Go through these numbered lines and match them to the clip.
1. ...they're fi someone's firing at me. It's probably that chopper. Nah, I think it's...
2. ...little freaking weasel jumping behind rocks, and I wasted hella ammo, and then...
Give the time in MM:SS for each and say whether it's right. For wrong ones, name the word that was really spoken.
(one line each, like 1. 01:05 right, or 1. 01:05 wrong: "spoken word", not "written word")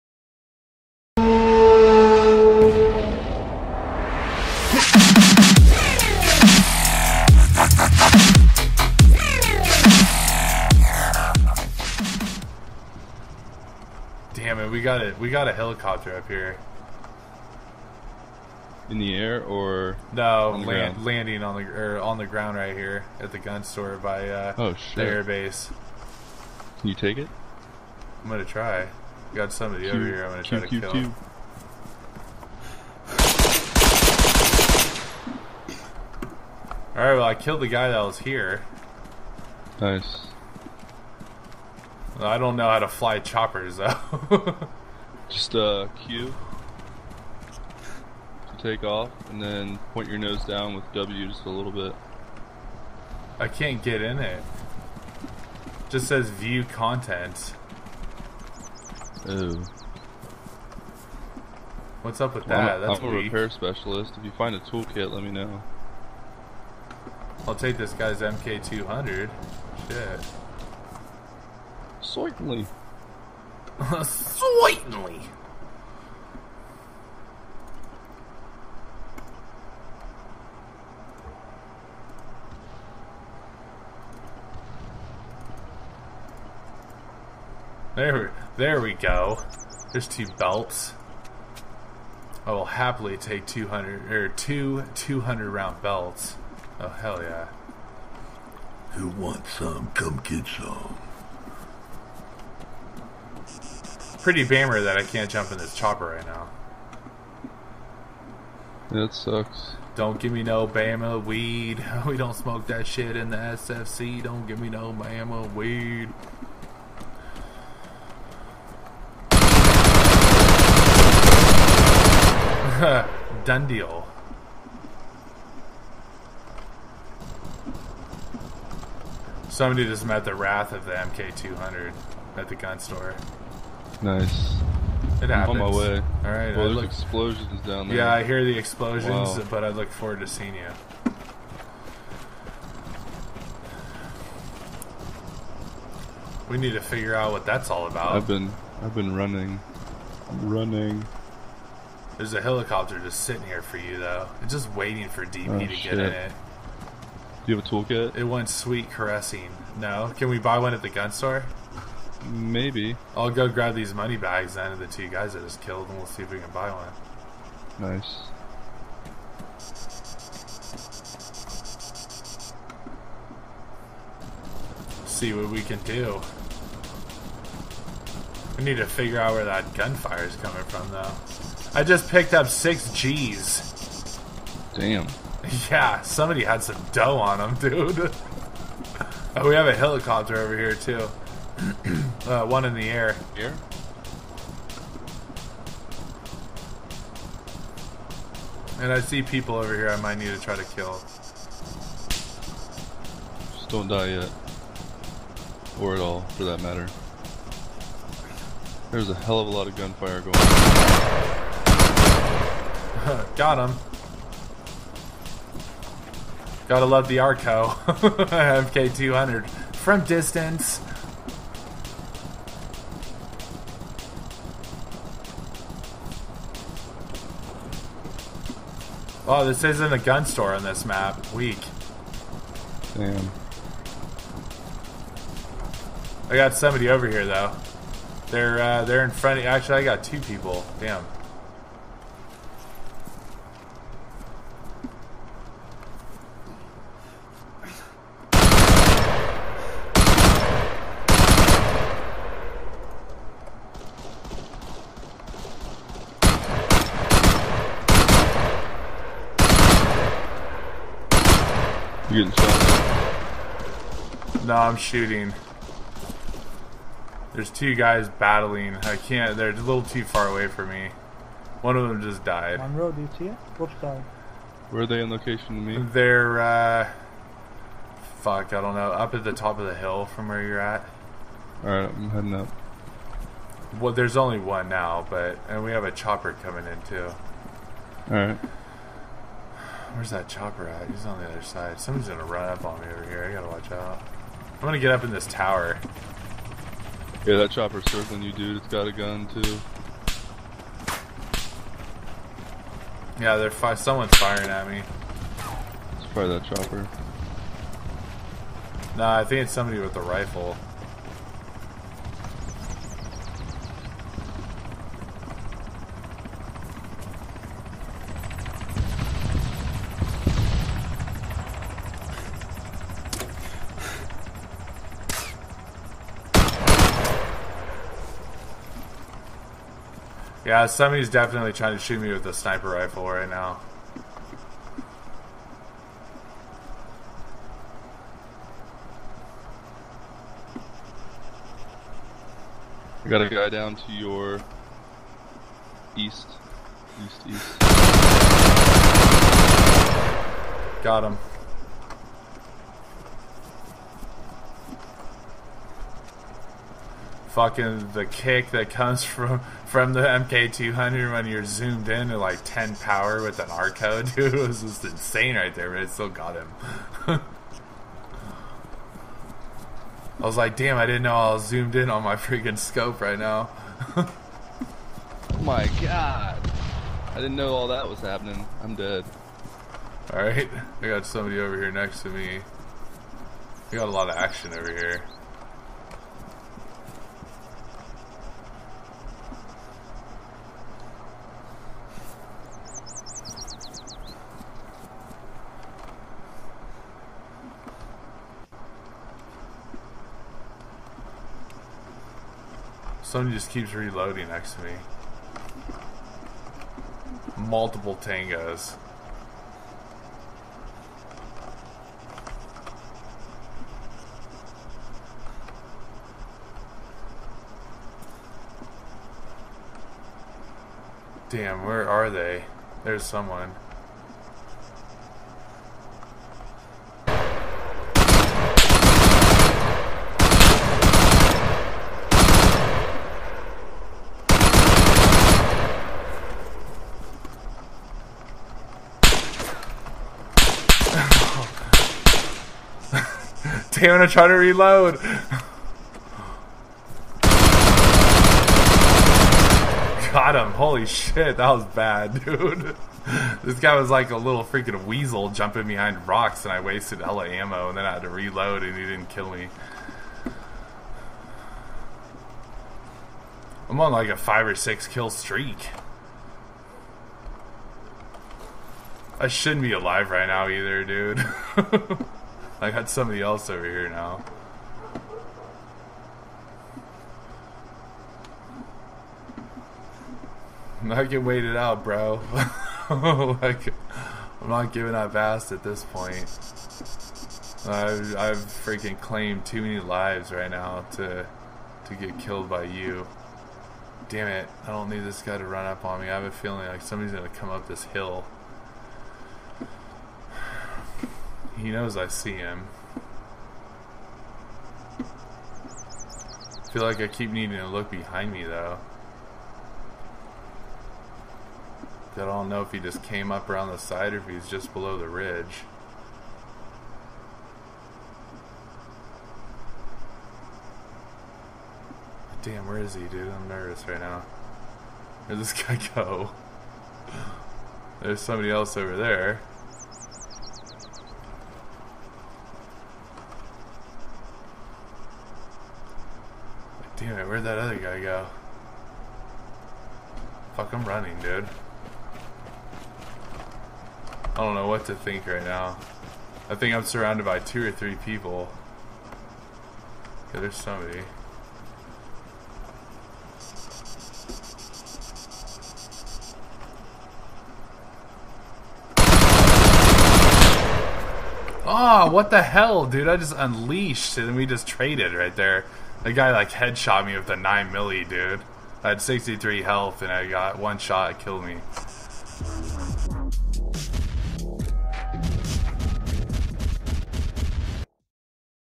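1. 05:03 right
2. 07:34 right.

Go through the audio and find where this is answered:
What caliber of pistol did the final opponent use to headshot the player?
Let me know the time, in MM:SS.
09:27.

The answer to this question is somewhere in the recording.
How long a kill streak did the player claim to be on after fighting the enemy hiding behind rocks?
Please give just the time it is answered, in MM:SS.
07:44.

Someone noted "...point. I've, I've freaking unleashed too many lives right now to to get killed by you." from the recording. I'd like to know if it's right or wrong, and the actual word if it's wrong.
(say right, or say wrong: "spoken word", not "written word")
wrong: "claimed", not "unleashed".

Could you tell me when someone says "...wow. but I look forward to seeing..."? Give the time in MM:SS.
02:19.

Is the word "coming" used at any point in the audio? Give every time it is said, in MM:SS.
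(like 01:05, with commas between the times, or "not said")
03:00, 04:46.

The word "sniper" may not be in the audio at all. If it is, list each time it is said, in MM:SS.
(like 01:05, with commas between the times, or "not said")
05:32.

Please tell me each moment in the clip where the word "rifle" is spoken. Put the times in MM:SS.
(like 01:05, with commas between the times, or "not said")
05:10, 05:32.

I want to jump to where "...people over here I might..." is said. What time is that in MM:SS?
03:19.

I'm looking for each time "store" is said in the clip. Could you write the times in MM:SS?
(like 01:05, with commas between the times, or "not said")
00:23, 02:12, 02:41, 03:50.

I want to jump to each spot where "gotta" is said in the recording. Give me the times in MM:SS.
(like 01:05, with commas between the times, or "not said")
03:36, 04:53.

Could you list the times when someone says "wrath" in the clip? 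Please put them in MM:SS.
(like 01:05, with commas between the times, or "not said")
02:10.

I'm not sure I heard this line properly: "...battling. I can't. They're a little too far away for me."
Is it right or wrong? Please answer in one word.
right.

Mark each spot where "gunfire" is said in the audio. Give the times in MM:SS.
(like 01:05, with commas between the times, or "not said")
02:59, 03:29.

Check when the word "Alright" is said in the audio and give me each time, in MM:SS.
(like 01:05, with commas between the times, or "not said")
04:41, 04:48, 06:20.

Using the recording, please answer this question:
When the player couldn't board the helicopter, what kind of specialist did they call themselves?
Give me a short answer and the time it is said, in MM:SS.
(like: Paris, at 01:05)
Repair specialist, at 01:03.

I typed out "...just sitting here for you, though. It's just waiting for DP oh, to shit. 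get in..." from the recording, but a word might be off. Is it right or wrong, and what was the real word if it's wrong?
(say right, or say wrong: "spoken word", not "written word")
right.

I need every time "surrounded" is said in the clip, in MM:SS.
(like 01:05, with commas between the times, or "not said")
09:06.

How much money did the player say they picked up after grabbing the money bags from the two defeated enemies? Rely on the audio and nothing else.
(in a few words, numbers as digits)
6 G's.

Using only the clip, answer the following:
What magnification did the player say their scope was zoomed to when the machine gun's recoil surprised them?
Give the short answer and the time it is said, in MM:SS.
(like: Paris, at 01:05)
10 power, at 06:02.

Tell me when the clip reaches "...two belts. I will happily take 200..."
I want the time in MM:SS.
01:30.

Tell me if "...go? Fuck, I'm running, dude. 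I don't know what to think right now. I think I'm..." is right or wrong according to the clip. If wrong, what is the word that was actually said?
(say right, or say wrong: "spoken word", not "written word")
right.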